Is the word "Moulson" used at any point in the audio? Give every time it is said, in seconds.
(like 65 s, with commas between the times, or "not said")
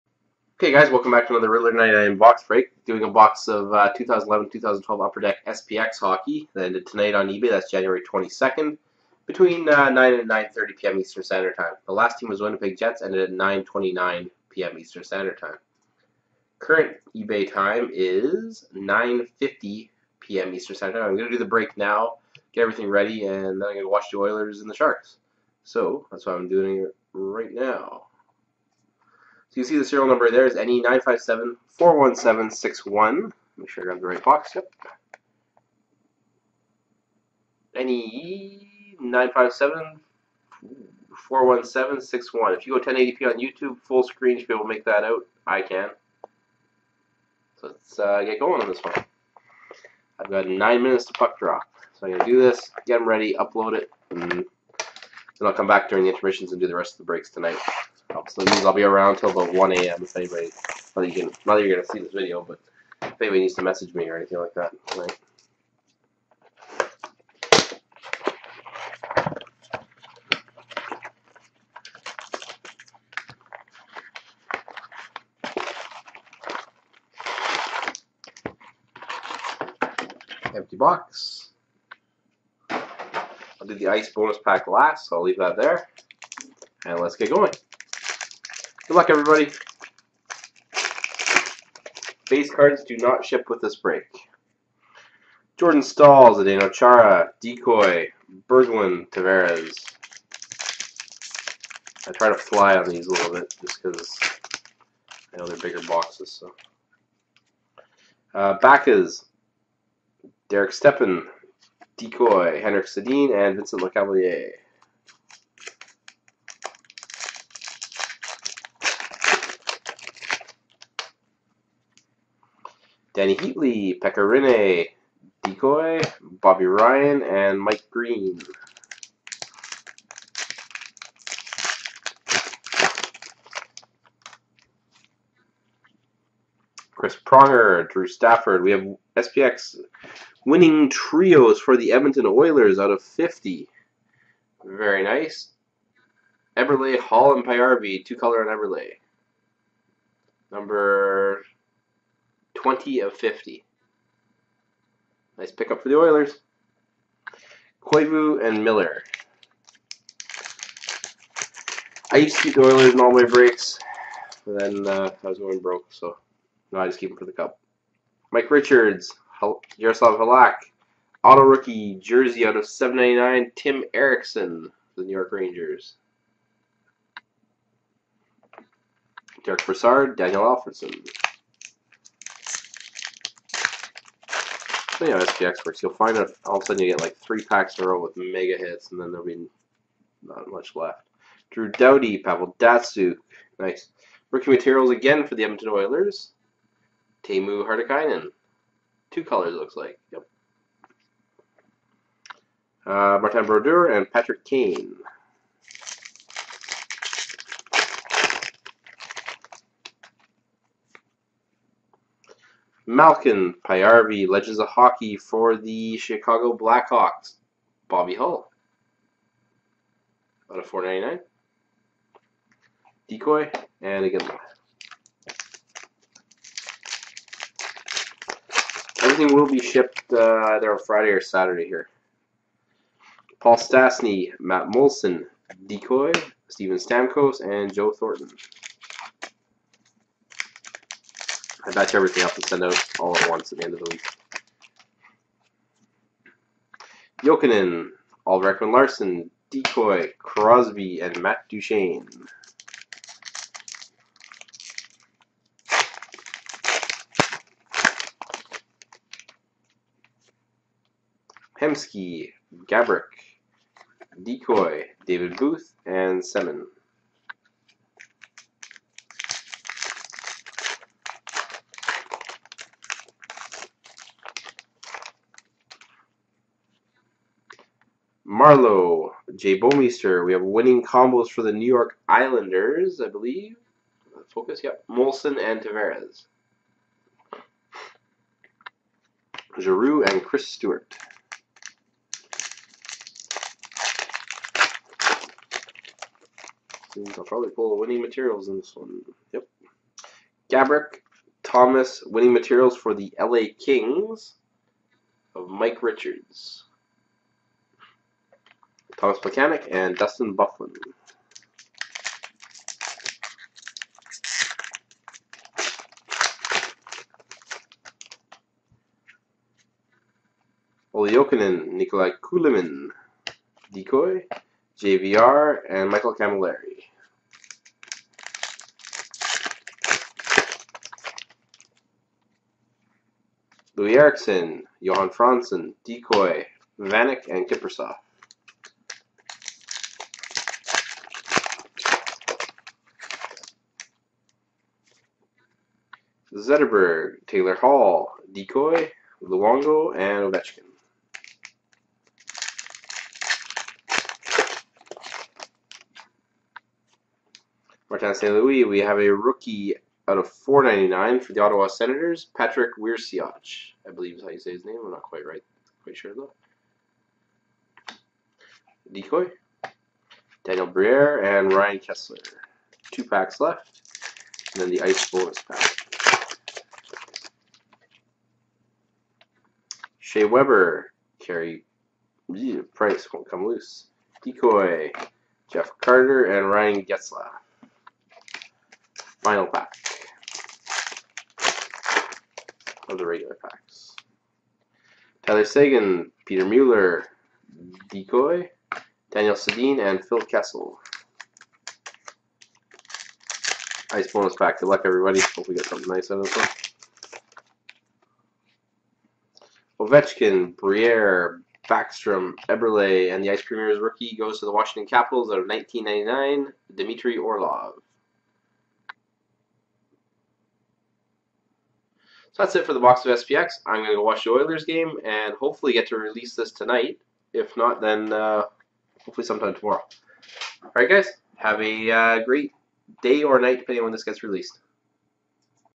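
234 s, 284 s.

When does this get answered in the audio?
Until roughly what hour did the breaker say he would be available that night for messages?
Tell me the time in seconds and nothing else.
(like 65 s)
59 s.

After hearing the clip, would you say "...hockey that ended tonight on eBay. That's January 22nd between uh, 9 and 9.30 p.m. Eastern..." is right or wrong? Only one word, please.
right.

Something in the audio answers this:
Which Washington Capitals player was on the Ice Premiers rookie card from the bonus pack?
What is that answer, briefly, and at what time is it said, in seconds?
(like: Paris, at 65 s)
Dmitry Orlov, at 416 s.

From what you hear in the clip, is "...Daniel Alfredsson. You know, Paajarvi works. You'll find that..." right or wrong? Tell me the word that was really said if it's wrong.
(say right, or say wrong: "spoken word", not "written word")
wrong: "SPX", not "Paajarvi".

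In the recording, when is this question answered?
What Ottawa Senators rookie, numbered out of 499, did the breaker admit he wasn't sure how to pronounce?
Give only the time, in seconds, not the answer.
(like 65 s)
362 s.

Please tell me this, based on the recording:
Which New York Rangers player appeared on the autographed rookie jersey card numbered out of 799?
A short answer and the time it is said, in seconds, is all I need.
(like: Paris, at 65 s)
Tim Erixon, at 173 s.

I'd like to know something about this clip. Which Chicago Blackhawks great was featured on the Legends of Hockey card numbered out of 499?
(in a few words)
Bobby Hull.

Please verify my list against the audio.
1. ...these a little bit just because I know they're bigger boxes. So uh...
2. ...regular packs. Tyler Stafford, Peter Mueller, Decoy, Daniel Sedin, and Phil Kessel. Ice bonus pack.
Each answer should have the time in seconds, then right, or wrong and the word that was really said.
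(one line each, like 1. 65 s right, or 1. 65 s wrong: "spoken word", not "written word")
1. 102 s right
2. 393 s wrong: "Seguin", not "Stafford".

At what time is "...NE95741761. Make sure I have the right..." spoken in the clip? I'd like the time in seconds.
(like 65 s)
30 s.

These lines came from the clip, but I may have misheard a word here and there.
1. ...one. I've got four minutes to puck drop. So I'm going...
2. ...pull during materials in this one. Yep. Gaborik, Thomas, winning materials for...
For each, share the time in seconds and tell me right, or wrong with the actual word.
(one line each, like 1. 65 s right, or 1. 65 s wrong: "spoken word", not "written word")
1. 48 s wrong: "nine", not "four"
2. 297 s wrong: "winning", not "during".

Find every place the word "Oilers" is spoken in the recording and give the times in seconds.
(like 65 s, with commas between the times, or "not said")
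24 s, 142 s, 155 s, 162 s, 195 s, 424 s.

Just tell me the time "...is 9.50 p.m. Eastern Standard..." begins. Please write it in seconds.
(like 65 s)
17 s.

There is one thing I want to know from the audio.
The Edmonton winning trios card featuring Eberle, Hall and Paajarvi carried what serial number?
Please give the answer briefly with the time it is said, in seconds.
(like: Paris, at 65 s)
20 of 50, at 150 s.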